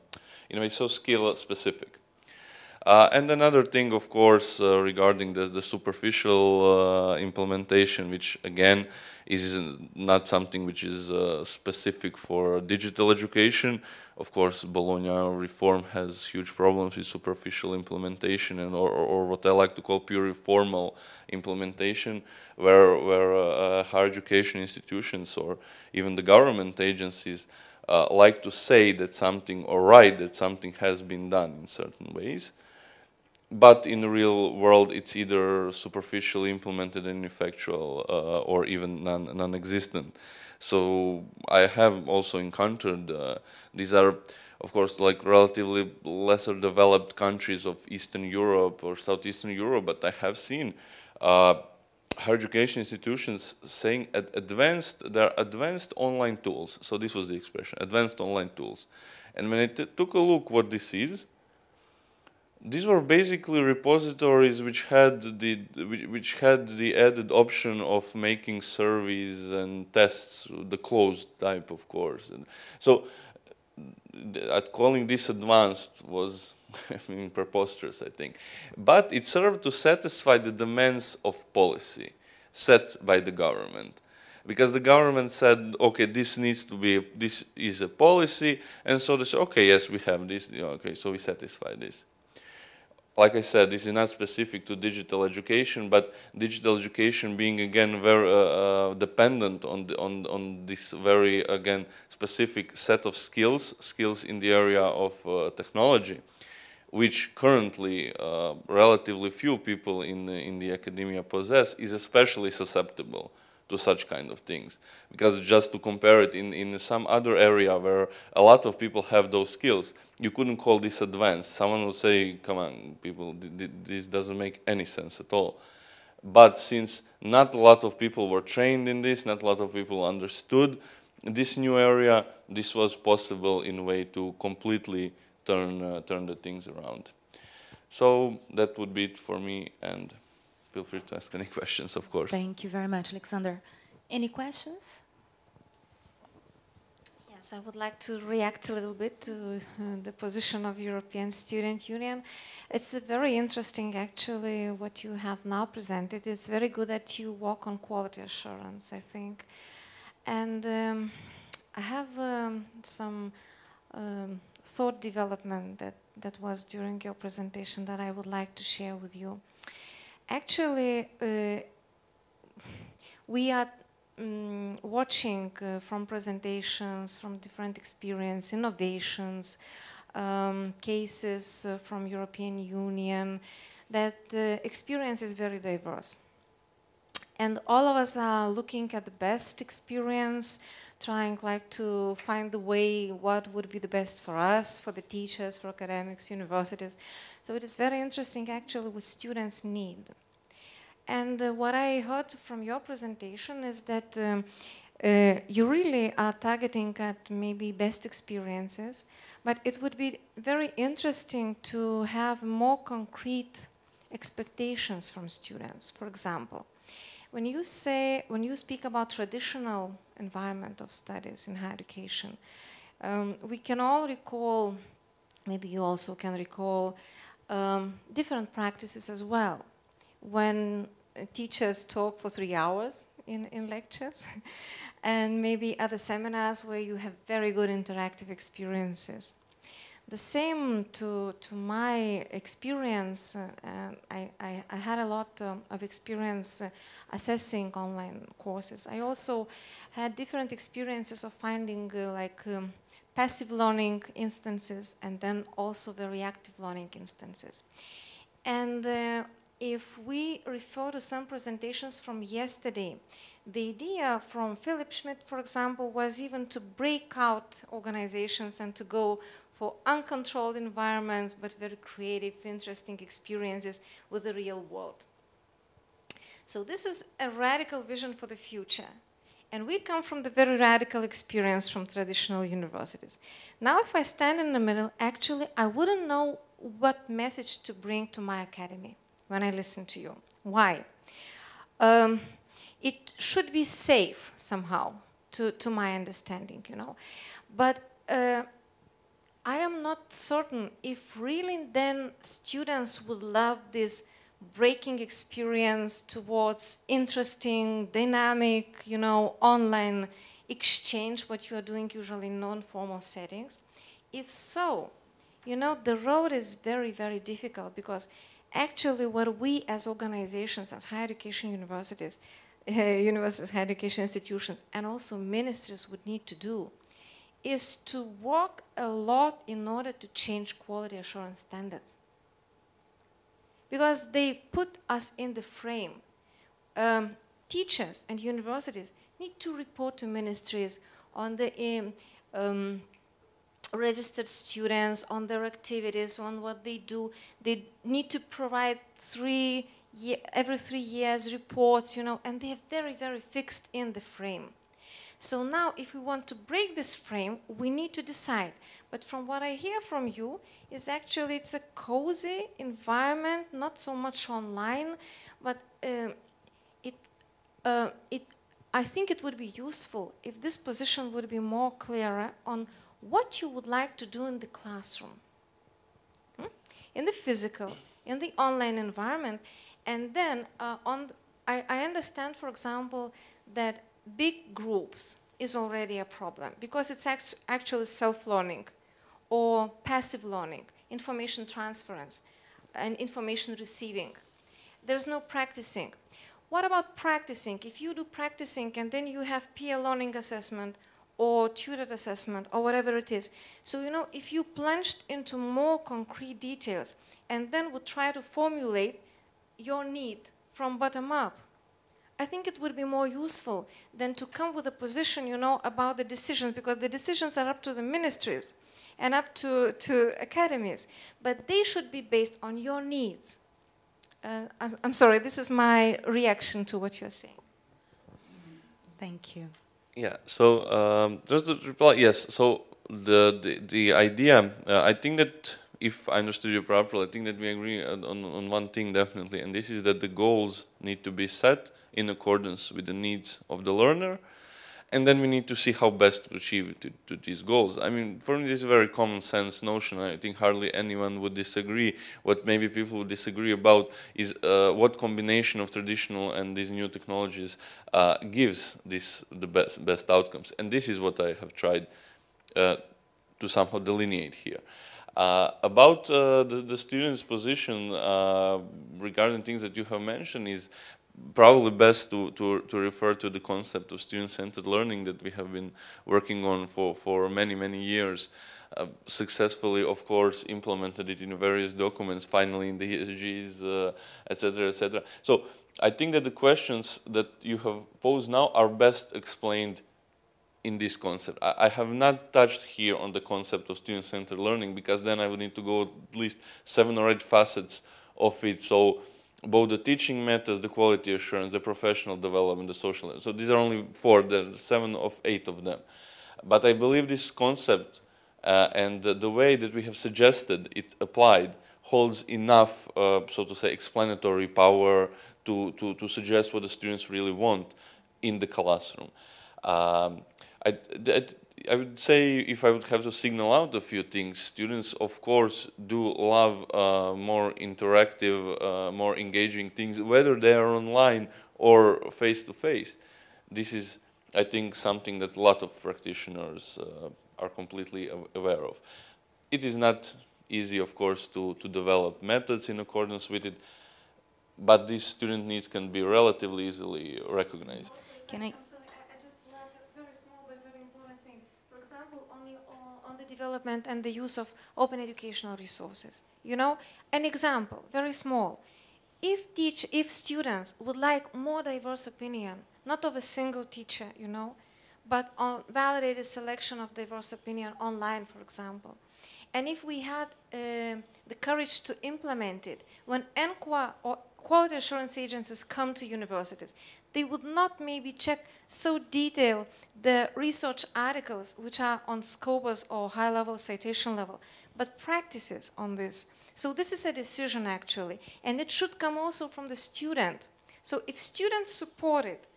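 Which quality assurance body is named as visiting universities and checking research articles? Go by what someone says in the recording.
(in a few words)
ENQA.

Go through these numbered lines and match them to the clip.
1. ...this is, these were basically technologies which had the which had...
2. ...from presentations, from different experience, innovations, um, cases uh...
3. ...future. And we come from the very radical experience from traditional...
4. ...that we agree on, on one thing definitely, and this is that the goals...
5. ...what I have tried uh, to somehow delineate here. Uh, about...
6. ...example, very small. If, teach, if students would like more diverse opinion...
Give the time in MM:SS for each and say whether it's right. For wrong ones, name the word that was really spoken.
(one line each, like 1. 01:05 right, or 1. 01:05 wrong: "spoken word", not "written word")
1. 01:00 wrong: "repositories", not "technologies"
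2. 02:55 right
3. 04:38 right
4. 07:17 right
5. 07:40 right
6. 09:17 right.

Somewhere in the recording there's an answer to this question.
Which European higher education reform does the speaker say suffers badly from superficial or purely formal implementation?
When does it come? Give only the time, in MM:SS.
00:14.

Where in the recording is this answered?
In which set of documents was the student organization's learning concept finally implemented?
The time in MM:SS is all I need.
08:03.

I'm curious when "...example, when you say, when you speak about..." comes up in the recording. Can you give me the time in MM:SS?
03:36.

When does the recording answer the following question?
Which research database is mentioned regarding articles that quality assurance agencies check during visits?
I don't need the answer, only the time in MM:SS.
09:42.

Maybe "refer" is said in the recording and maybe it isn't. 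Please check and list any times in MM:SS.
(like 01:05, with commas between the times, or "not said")
04:20, 07:52.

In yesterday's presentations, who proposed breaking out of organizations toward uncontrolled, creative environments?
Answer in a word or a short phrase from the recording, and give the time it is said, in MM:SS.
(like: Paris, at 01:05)
Philipp Schmidt, at 04:24.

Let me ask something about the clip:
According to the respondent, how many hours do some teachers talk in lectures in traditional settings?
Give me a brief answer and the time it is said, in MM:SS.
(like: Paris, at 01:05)
3, at 03:52.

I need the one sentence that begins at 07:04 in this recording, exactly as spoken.
Uh, I'm sorry, this is my reaction to what you're saying.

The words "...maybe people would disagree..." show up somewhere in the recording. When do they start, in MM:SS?
07:32.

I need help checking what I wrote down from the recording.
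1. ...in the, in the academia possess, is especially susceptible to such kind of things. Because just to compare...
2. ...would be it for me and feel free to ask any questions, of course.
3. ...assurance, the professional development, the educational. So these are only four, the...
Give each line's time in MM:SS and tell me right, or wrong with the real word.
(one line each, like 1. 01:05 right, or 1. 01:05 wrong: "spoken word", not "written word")
1. 01:50 right
2. 02:18 right
3. 08:21 wrong: "social", not "educational".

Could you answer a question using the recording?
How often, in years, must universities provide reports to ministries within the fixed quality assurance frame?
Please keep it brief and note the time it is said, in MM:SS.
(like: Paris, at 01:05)
every 3 years, at 05:50.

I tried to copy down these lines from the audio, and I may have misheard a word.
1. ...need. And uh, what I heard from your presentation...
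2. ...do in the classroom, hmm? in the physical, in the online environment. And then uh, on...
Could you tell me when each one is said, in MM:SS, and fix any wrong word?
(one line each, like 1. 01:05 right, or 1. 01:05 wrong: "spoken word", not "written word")
1. 03:19 right
2. 06:14 right.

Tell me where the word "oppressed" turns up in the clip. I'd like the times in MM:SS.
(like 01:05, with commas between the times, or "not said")
not said.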